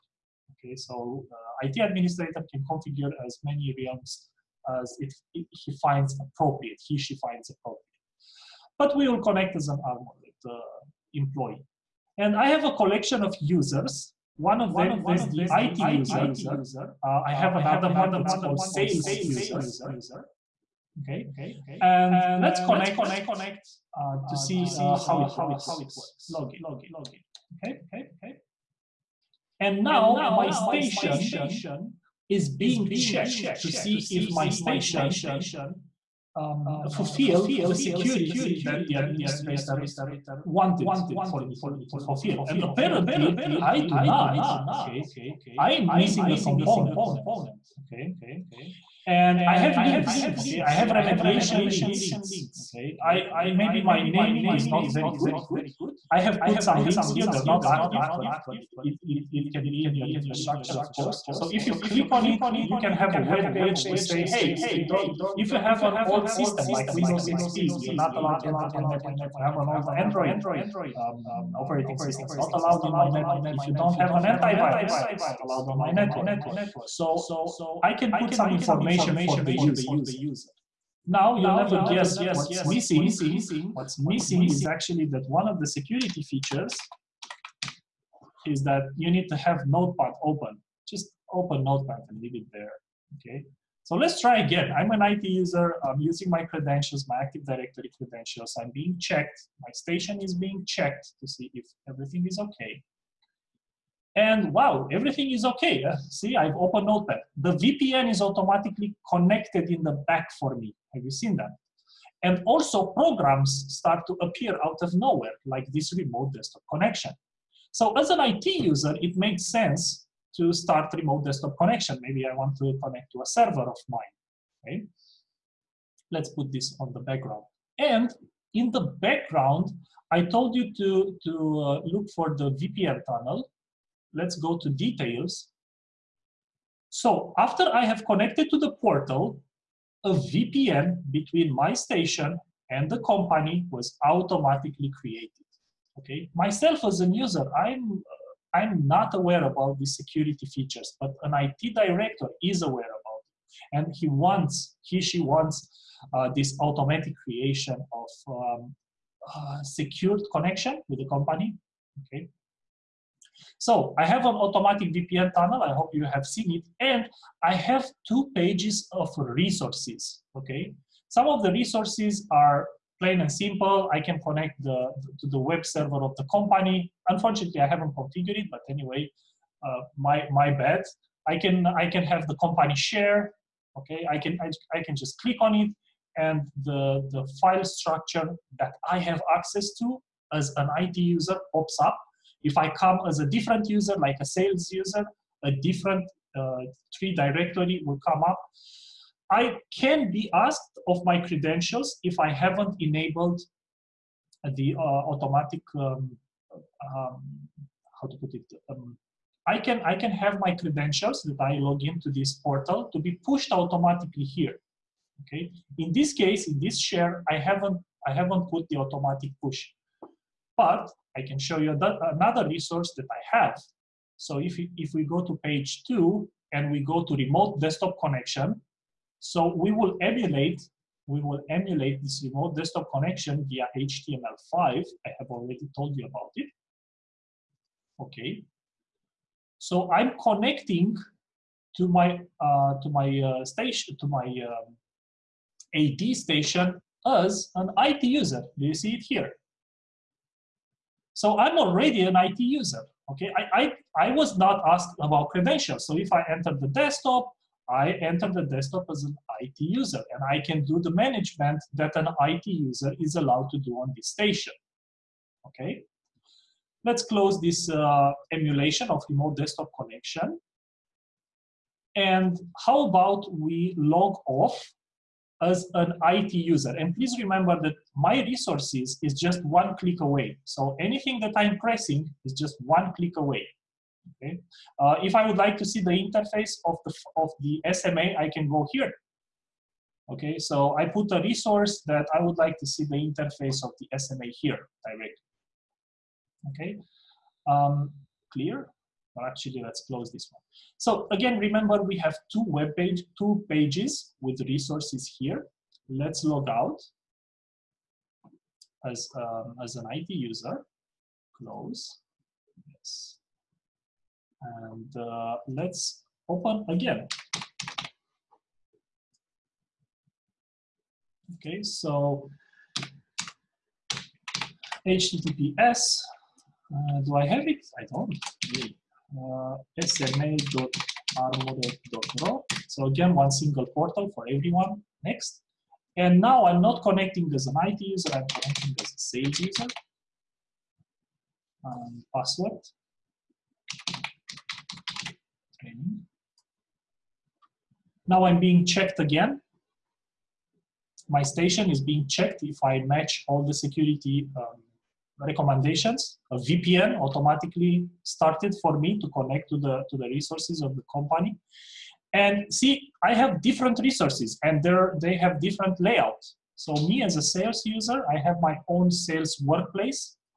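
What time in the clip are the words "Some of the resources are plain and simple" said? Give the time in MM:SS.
02:51.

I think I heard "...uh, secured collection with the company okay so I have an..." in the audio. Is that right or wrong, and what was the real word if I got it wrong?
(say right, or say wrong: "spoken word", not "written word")
wrong: "connection", not "collection".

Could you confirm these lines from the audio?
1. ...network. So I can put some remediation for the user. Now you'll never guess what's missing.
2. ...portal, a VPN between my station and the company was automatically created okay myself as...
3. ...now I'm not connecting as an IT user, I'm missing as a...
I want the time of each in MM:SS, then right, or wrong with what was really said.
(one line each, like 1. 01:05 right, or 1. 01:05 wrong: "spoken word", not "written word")
1. 01:15 wrong: "information", not "remediation"
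2. 02:18 right
3. 05:36 wrong: "connecting", not "missing".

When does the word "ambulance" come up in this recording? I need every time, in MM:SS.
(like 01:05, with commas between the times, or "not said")
not said.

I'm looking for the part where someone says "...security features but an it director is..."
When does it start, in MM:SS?
02:29.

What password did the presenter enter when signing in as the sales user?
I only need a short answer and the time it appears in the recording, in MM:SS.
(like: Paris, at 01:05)
training, at 05:42.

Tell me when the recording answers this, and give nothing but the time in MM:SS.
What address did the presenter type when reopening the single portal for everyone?
05:29.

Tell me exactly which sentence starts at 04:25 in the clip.
Okay, let's close this uh, emulation of remote desktop connection.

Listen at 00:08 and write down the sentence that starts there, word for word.
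But we will connect as an armored uh, employee.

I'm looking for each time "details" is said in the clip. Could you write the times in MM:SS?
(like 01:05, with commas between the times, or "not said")
02:14.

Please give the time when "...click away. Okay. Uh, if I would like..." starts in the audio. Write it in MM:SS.
04:42.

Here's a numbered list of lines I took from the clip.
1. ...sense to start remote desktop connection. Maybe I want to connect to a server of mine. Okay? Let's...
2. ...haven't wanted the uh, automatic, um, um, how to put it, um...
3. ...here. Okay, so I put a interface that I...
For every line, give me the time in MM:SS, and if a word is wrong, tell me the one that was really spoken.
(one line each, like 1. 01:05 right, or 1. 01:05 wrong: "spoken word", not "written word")
1. 01:59 right
2. 03:22 wrong: "enabled", not "wanted"
3. 04:48 wrong: "resource", not "interface".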